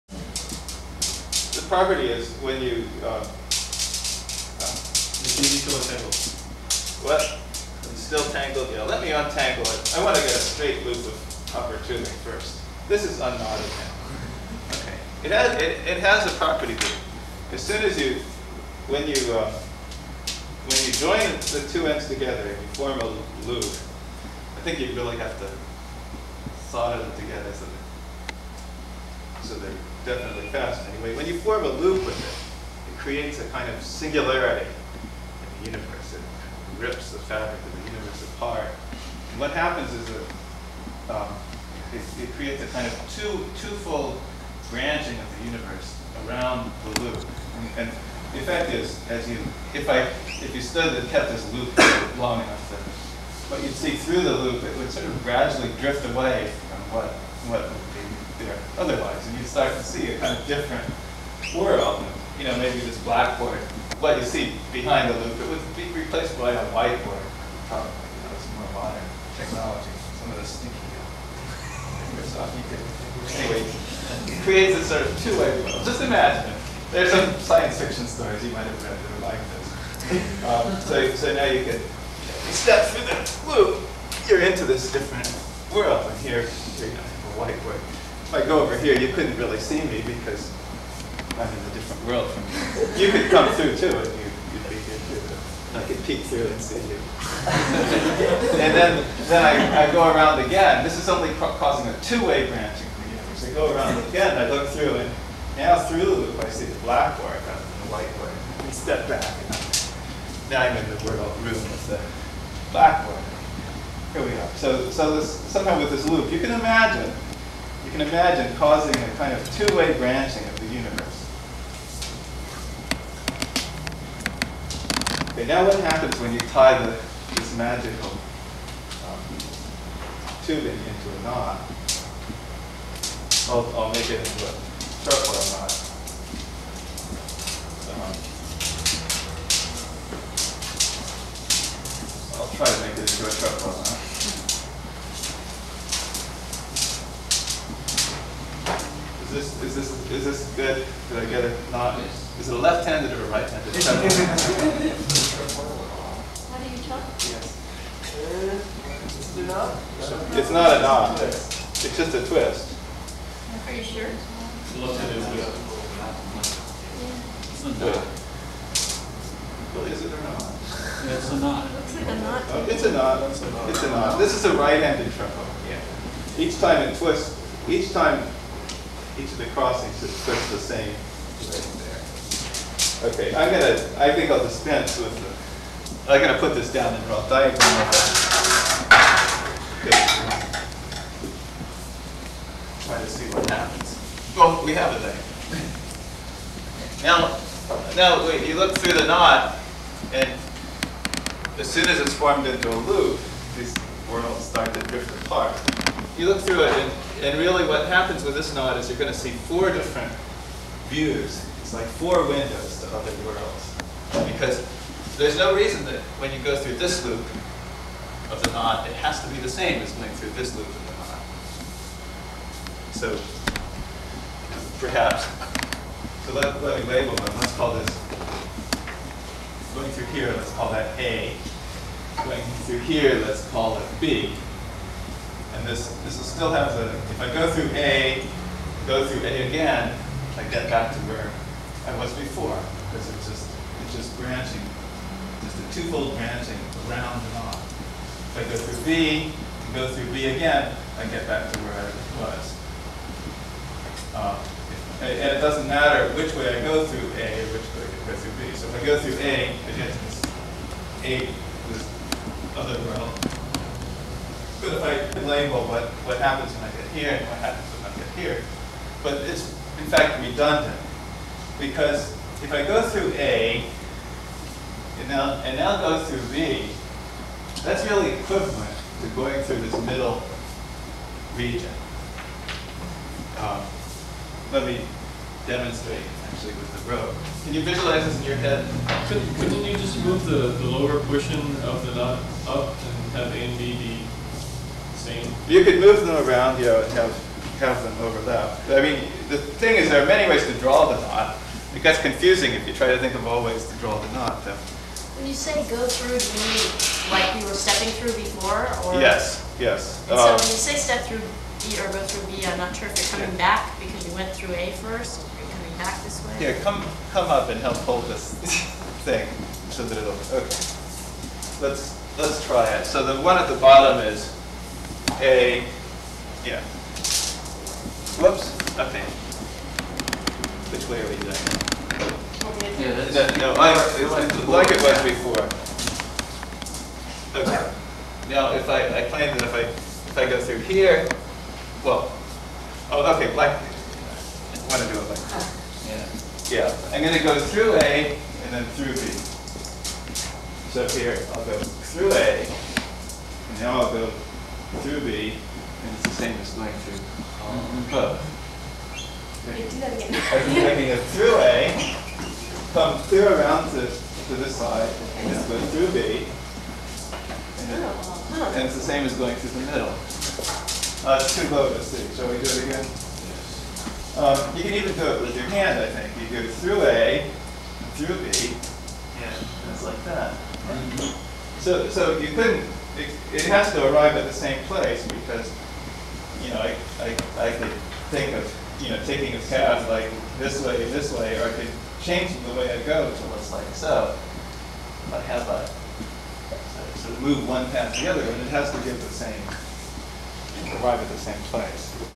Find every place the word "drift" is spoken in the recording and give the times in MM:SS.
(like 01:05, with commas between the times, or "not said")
00:55, 03:24.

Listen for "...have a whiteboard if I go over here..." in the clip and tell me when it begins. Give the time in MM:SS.
01:26.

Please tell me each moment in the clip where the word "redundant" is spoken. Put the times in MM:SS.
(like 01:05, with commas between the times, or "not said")
04:30.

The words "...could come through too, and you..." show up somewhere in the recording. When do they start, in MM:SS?
01:33.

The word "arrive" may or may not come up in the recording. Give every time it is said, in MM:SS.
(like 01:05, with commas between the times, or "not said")
06:23, 06:40.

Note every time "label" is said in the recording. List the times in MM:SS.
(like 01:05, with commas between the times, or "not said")
03:46, 04:25.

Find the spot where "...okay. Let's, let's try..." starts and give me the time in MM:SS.
05:20.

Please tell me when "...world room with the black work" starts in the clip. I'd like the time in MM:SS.
01:51.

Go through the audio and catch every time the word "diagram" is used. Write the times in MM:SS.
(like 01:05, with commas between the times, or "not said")
03:07, 03:14.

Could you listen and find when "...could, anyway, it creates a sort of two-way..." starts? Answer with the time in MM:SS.
01:12.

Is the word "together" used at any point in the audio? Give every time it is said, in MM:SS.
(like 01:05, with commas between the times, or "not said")
00:22, 00:27.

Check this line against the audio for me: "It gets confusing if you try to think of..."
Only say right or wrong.
right.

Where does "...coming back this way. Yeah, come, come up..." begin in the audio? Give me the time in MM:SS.
05:15.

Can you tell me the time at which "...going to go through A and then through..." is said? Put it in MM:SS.
05:47.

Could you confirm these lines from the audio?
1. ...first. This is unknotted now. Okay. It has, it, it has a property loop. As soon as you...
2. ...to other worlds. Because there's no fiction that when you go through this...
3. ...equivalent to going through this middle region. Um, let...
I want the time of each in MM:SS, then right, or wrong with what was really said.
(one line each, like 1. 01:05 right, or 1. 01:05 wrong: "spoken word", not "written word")
1. 00:12 right
2. 03:32 wrong: "reason", not "fiction"
3. 04:38 right.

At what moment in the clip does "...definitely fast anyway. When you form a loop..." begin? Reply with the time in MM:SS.
00:30.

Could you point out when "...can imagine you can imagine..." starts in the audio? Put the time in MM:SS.
01:56.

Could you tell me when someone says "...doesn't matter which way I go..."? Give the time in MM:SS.
04:15.